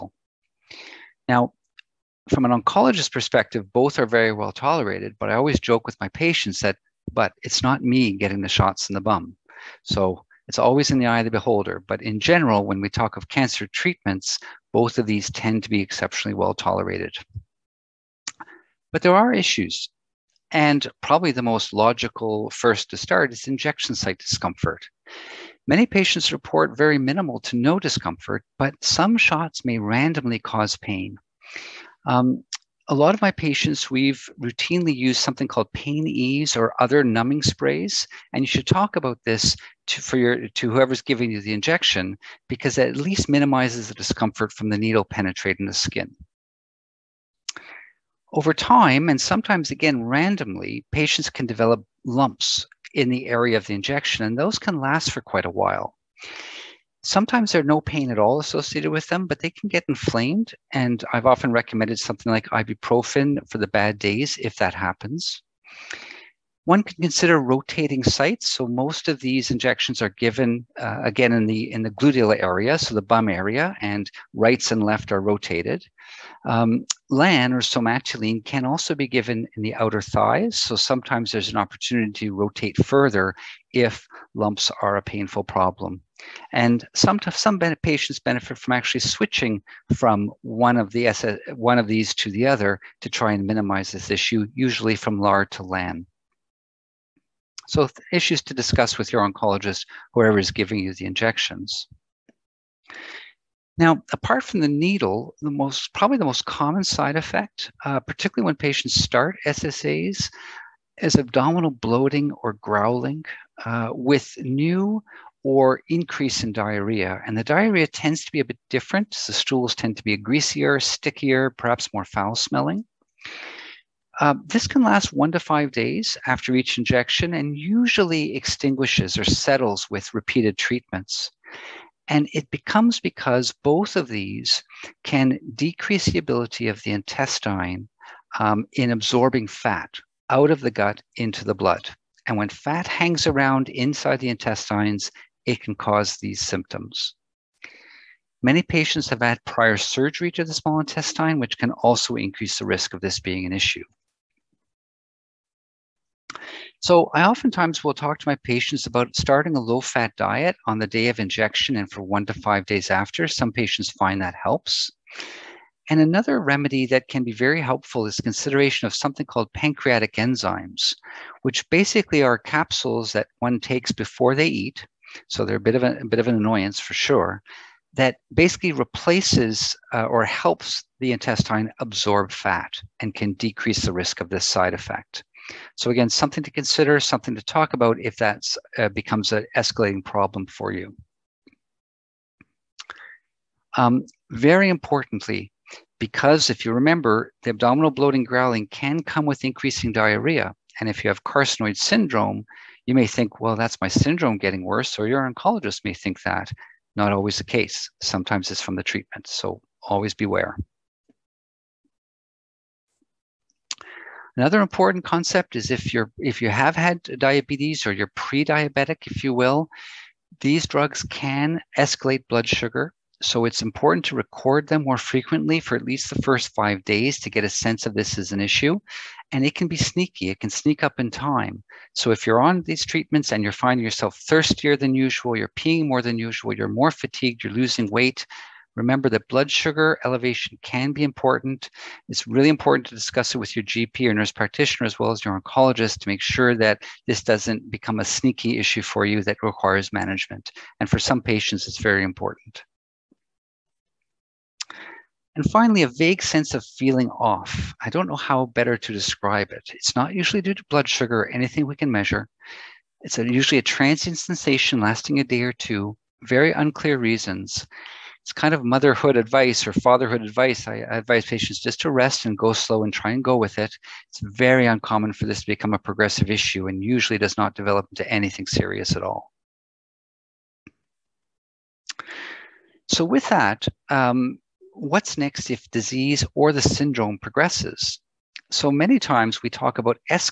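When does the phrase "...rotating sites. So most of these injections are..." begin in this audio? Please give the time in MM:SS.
01:07.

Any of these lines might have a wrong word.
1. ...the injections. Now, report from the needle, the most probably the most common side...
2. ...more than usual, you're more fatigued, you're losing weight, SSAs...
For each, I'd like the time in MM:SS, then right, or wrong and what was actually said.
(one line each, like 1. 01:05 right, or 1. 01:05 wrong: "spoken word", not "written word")
1. 01:40 wrong: "apart", not "report"
2. 03:55 wrong: "Remember", not "SSAs".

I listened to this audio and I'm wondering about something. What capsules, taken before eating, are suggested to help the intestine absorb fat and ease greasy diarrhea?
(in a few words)
Pancreatic enzymes.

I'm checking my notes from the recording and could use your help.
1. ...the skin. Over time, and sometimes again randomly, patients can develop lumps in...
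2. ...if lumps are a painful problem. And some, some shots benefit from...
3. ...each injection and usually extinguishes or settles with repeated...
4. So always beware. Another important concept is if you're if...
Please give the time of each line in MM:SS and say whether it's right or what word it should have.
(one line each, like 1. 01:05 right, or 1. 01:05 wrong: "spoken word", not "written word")
1. 00:45 right
2. 01:23 wrong: "patients", not "shots"
3. 02:06 right
4. 03:29 right.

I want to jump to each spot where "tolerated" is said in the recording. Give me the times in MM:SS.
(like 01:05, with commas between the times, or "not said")
00:04, 00:16.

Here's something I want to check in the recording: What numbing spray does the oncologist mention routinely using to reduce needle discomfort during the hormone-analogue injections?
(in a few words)
Pain Ease.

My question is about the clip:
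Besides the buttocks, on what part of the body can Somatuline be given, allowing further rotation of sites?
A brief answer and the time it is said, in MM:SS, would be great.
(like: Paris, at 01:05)
Outer thighs, at 01:19.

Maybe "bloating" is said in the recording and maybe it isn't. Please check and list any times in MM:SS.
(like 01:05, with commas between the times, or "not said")
01:51, 03:17.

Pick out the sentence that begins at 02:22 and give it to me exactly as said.
And when fat hangs around inside the intestines, it can cause these symptoms.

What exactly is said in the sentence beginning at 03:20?
And if you have carcinoid syndrome, you may think, well, that's my syndrome getting worse, or your oncologist may think that.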